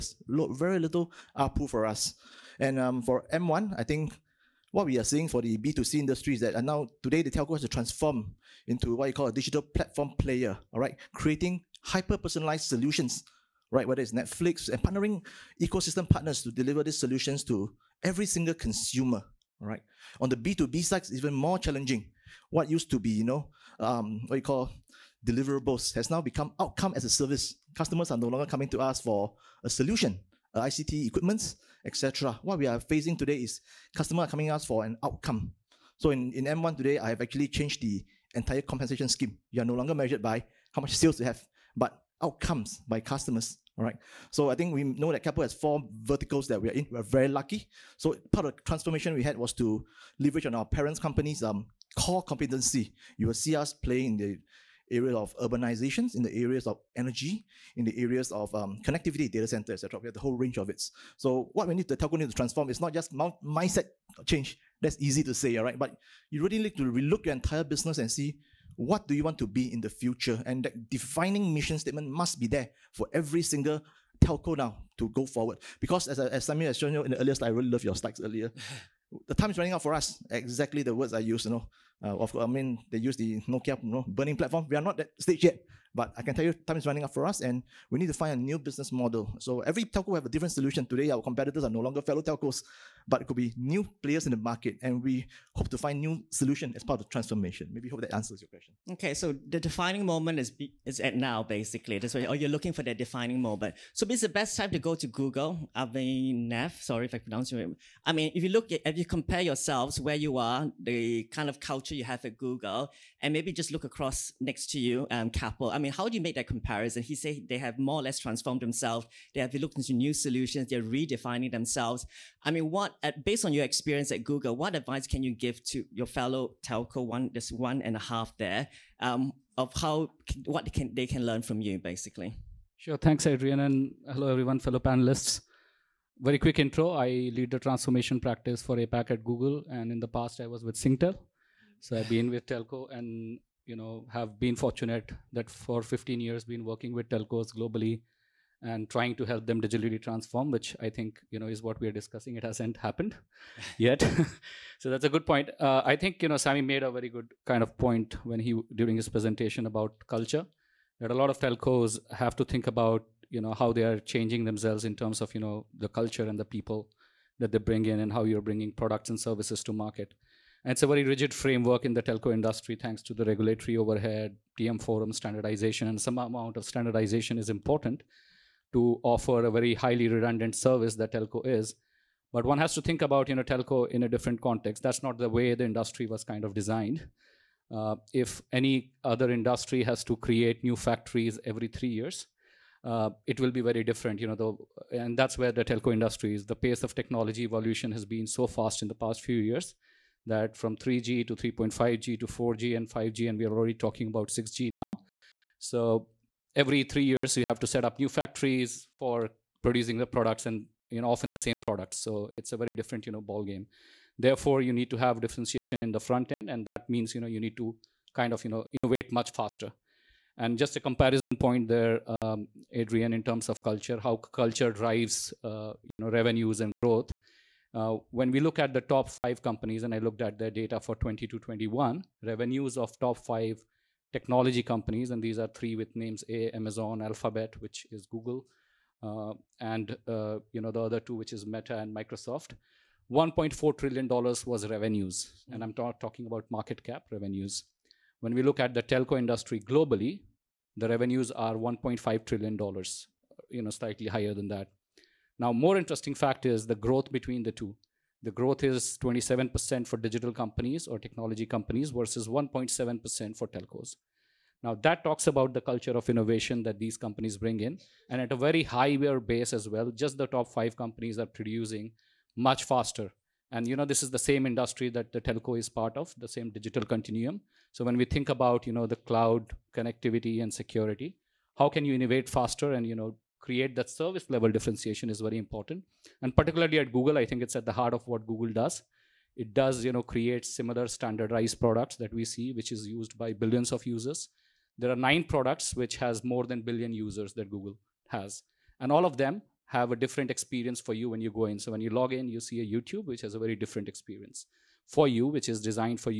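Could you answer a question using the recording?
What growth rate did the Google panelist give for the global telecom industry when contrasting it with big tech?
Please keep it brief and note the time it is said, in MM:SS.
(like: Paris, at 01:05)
1.7%, at 04:22.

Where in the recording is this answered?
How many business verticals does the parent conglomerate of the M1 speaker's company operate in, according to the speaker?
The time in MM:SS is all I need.
00:45.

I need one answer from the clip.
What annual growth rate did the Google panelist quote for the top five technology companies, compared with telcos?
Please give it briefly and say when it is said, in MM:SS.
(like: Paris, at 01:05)
27%, at 04:19.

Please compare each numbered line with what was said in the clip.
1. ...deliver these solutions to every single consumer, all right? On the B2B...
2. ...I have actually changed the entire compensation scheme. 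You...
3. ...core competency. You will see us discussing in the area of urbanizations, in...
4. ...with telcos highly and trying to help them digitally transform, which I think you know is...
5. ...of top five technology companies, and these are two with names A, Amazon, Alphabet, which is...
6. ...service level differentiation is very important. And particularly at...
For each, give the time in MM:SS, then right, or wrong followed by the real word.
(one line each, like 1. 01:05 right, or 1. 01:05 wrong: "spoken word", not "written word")
1. 00:16 right
2. 00:36 right
3. 00:51 wrong: "playing", not "discussing"
4. 02:26 wrong: "globally", not "highly"
5. 03:52 wrong: "three", not "two"
6. 04:43 right.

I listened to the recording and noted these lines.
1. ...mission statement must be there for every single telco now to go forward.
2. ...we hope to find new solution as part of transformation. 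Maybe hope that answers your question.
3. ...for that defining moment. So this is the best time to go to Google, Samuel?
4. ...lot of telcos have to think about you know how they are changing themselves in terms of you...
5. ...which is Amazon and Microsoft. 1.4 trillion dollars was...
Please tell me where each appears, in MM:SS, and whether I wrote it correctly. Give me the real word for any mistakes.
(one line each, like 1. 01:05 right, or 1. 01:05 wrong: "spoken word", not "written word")
1. 01:11 right
2. 01:35 right
3. 01:42 wrong: "Avinav", not "Samuel"
4. 02:41 right
5. 04:01 wrong: "Meta", not "Amazon".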